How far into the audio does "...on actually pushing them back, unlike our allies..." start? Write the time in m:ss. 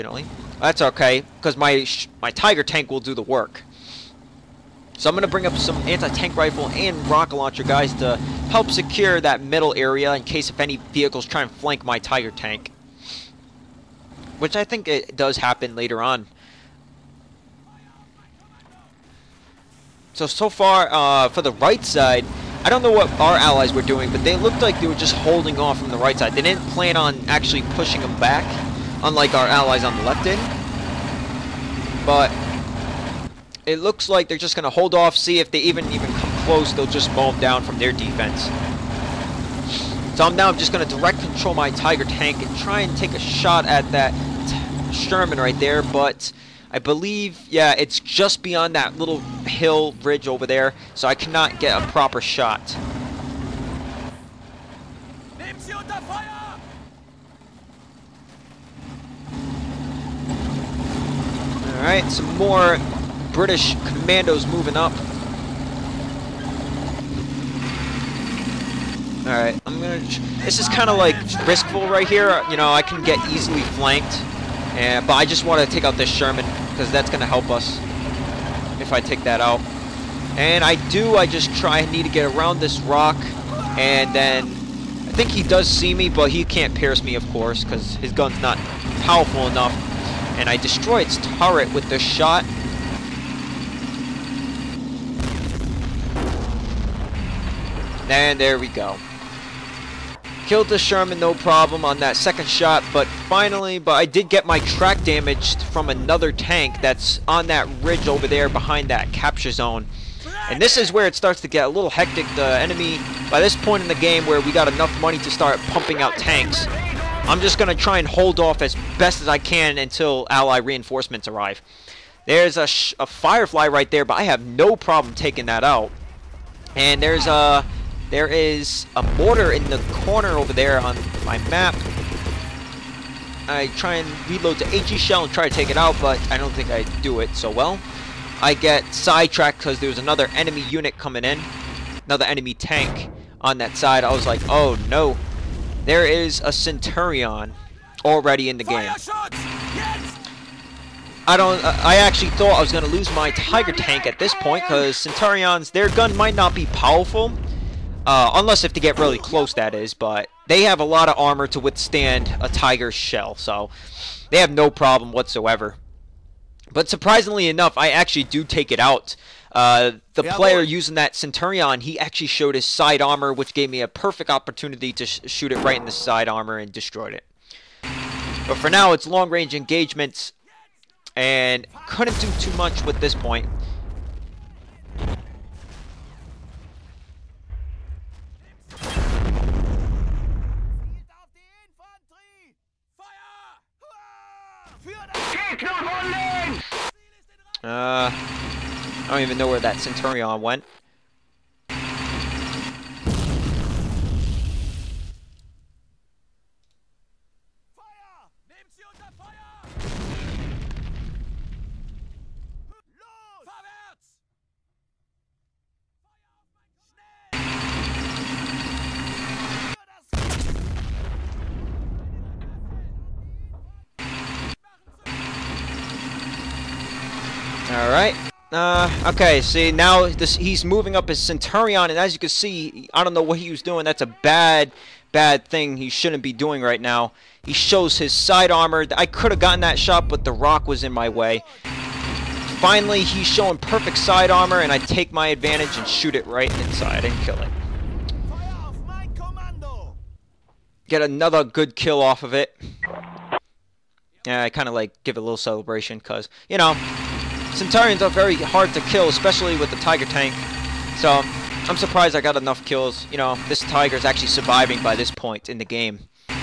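0:26.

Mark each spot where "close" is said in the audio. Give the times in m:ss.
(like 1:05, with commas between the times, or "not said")
0:36, 2:39.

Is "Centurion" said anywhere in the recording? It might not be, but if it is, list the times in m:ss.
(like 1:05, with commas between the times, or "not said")
2:26, 2:34, 2:51, 3:19, 3:51, 4:17.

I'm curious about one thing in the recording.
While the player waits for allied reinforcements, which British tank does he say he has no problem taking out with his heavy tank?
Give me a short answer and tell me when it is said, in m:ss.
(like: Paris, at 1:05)
Firefly, at 2:03.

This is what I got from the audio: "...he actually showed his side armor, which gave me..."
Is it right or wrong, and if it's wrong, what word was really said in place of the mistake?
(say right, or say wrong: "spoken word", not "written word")
right.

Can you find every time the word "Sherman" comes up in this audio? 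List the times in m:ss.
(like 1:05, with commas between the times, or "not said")
0:44, 1:16, 1:40.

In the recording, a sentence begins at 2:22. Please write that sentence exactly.
Another enemy tank on that side.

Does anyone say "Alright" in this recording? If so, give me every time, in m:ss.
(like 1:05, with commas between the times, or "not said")
1:01, 1:09, 3:47.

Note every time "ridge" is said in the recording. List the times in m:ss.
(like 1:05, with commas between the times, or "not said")
0:50, 1:47.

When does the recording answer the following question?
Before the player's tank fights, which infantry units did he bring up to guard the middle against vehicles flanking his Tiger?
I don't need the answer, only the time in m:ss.
0:05.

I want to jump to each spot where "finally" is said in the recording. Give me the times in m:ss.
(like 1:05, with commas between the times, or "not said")
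1:43, 4:02.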